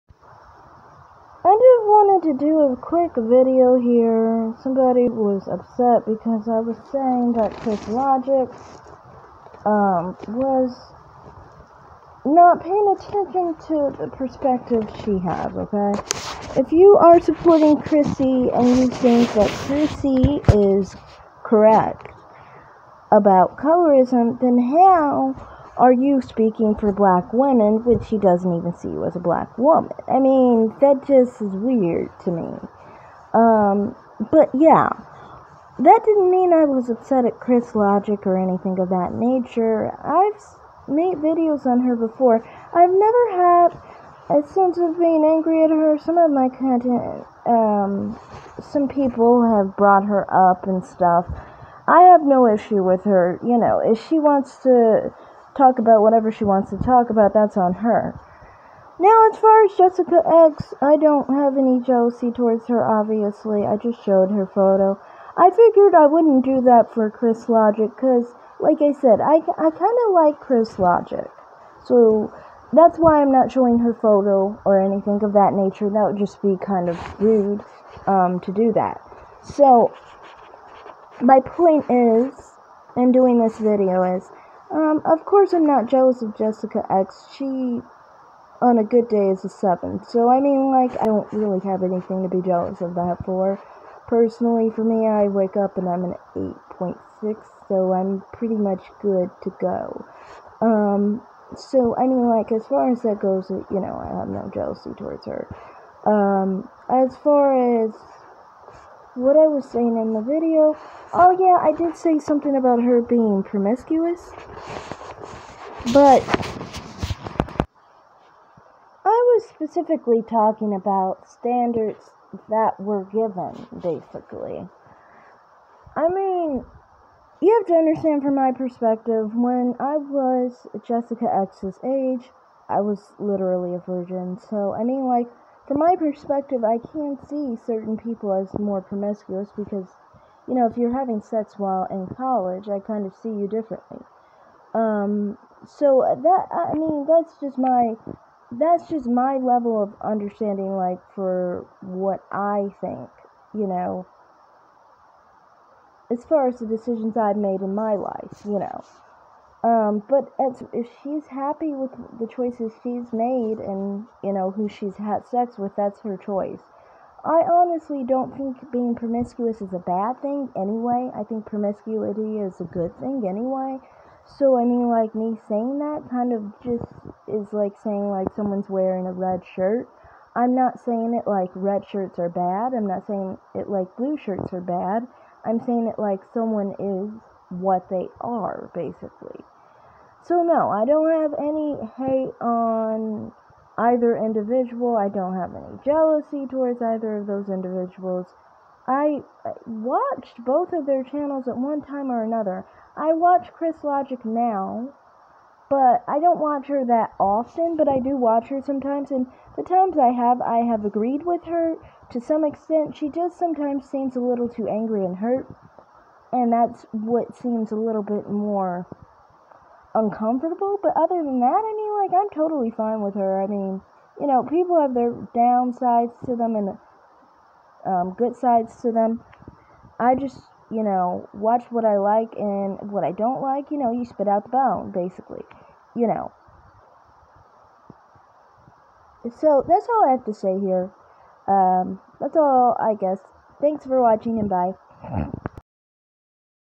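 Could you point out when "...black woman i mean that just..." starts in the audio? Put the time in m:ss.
0:29.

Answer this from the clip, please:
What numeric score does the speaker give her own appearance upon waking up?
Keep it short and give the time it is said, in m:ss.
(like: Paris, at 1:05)
8.6, at 1:36.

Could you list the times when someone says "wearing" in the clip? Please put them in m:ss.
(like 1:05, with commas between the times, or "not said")
2:58.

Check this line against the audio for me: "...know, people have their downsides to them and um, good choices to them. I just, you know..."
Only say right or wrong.
wrong.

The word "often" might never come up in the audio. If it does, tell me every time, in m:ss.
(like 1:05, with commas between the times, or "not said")
3:27.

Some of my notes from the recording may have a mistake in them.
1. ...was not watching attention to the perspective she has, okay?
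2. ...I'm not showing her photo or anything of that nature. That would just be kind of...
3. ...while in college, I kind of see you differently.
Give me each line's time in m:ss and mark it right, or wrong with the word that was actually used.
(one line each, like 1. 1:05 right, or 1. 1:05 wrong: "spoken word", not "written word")
1. 0:10 wrong: "paying", not "watching"
2. 1:13 right
3. 2:21 right.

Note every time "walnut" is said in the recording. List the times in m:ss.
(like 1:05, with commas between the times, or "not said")
not said.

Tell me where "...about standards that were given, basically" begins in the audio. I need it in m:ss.
2:00.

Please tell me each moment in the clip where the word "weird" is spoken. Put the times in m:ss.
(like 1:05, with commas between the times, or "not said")
0:31.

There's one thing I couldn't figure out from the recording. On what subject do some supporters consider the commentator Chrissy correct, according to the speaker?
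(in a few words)
colorism.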